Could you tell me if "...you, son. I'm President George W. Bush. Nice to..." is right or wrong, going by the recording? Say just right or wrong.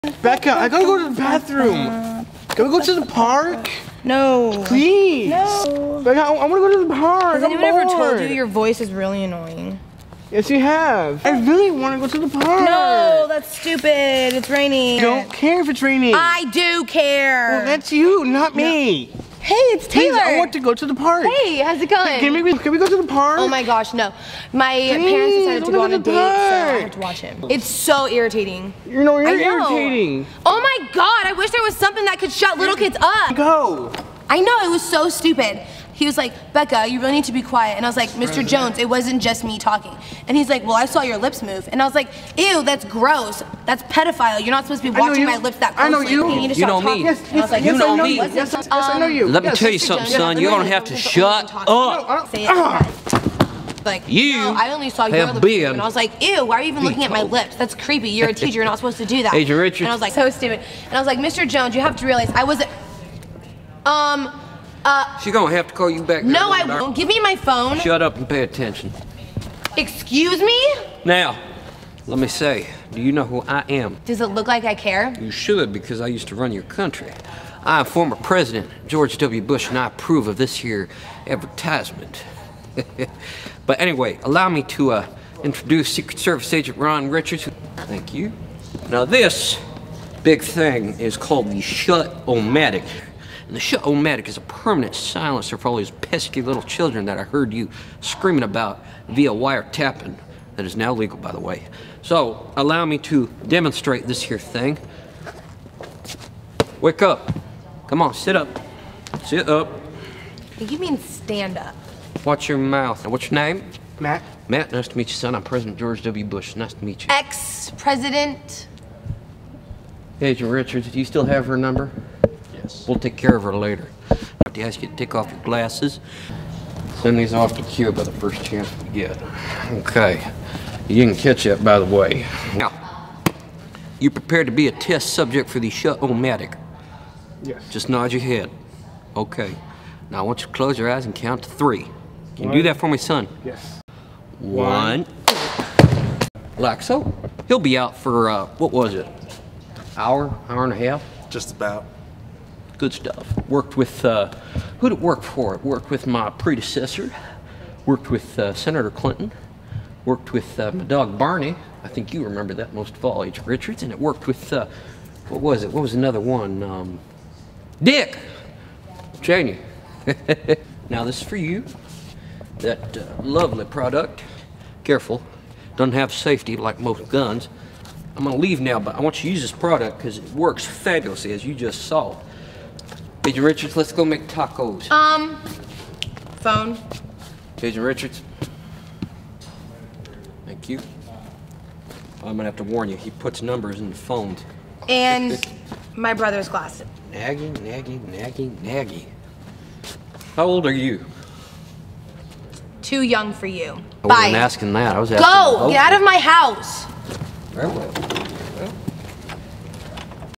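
right.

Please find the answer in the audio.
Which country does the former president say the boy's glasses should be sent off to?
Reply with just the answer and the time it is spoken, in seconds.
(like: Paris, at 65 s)
Cuba, at 127 s.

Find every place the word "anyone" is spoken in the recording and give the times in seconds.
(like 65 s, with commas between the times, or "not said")
7 s.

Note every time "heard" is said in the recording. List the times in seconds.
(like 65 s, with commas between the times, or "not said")
97 s.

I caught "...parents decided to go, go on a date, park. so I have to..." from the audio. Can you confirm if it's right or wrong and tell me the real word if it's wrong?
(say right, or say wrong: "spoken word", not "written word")
right.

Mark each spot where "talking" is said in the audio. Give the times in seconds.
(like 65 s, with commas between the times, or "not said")
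39 s, 46 s.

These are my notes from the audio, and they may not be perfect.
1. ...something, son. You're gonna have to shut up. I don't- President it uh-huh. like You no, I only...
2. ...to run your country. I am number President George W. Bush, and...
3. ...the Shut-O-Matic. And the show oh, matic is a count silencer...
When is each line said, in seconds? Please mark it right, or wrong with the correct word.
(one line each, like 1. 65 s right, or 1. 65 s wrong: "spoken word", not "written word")
1. 49 s wrong: "Say", not "President"
2. 76 s wrong: "former", not "number"
3. 91 s wrong: "permanent", not "count".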